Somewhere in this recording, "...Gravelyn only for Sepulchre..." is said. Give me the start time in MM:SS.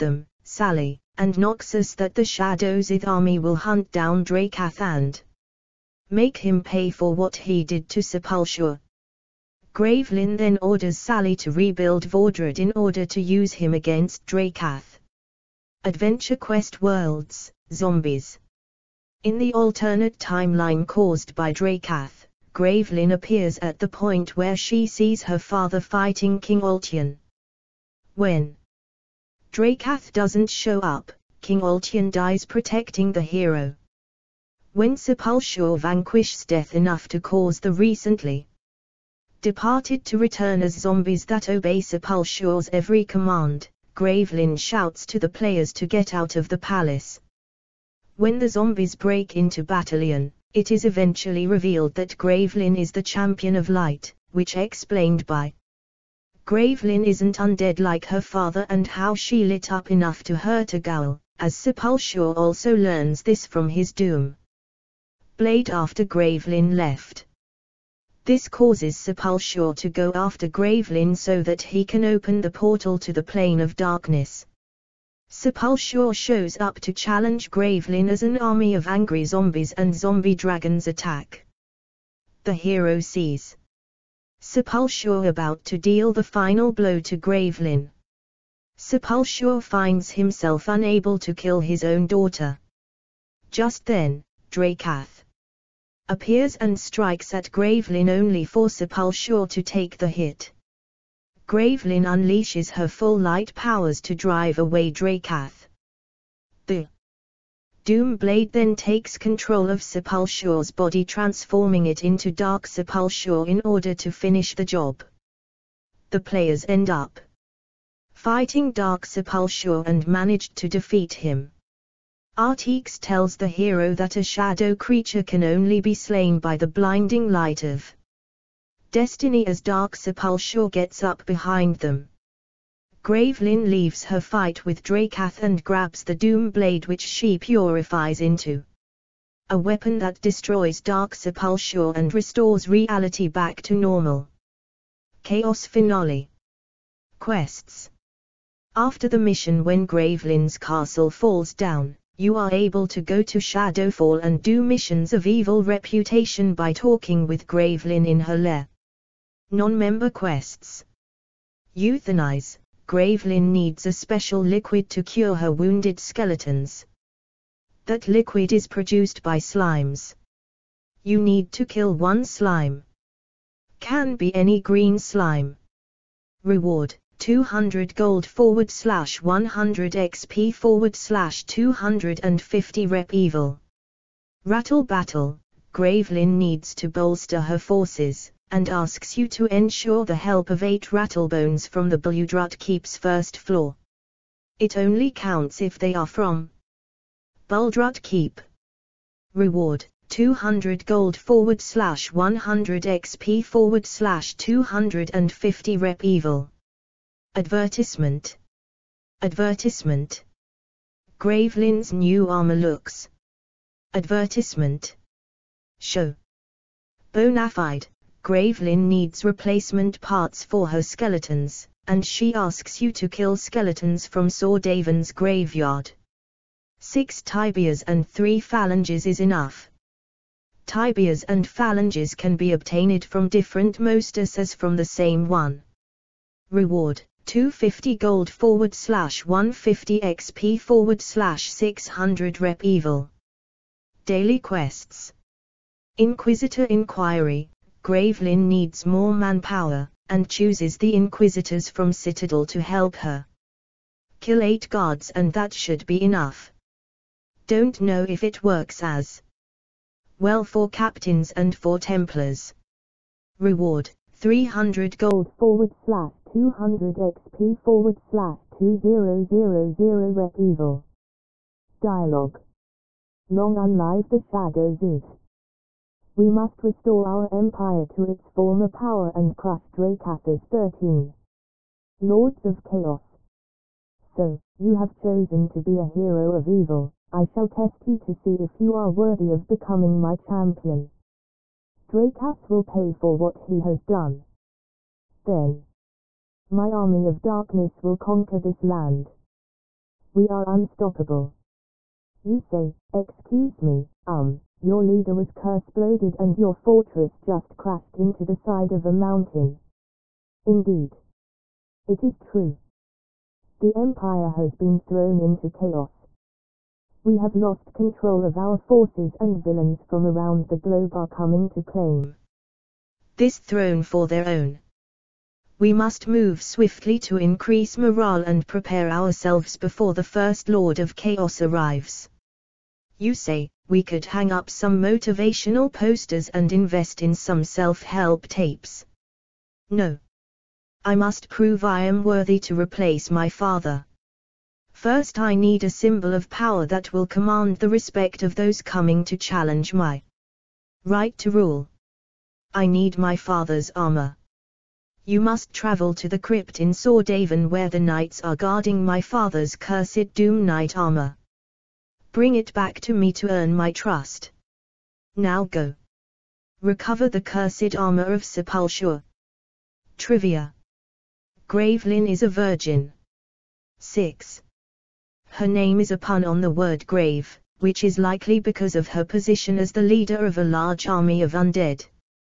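01:37.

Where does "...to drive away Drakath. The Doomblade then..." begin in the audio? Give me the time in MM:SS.
01:44.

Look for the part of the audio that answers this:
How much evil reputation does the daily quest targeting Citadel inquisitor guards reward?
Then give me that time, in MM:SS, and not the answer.
04:28.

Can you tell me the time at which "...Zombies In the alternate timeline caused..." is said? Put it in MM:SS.
00:17.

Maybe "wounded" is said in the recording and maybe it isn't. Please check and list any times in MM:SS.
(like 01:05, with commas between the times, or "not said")
02:45.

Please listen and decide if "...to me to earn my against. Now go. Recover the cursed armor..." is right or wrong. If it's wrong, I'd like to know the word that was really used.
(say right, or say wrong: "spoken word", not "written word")
wrong: "trust", not "against".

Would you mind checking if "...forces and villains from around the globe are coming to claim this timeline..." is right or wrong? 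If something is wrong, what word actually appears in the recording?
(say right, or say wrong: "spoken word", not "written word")
wrong: "throne", not "timeline".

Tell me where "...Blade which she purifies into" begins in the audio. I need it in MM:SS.
02:16.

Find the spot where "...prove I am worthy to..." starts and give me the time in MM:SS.
05:41.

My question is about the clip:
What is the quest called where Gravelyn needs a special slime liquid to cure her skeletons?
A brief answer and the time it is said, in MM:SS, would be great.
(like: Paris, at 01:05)
Euthanize, at 02:41.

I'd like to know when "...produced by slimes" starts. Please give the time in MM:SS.
02:48.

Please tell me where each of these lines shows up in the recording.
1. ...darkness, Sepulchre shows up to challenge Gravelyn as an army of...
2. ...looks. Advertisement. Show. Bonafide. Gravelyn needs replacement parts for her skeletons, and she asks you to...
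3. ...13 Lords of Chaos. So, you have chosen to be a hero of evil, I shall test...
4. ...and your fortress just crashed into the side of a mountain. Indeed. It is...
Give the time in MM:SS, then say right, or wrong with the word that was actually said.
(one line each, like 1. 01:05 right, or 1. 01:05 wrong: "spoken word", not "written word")
1. 01:13 right
2. 03:32 right
3. 04:40 right
4. 05:05 right.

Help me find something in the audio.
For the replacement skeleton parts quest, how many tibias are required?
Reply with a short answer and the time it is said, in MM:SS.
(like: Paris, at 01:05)
6, at 03:46.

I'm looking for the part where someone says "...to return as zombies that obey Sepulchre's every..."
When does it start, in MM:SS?
00:40.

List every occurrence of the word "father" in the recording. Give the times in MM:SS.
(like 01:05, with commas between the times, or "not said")
00:25, 00:58, 05:43, 05:53, 05:59.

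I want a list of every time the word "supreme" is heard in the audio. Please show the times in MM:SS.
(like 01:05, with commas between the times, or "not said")
not said.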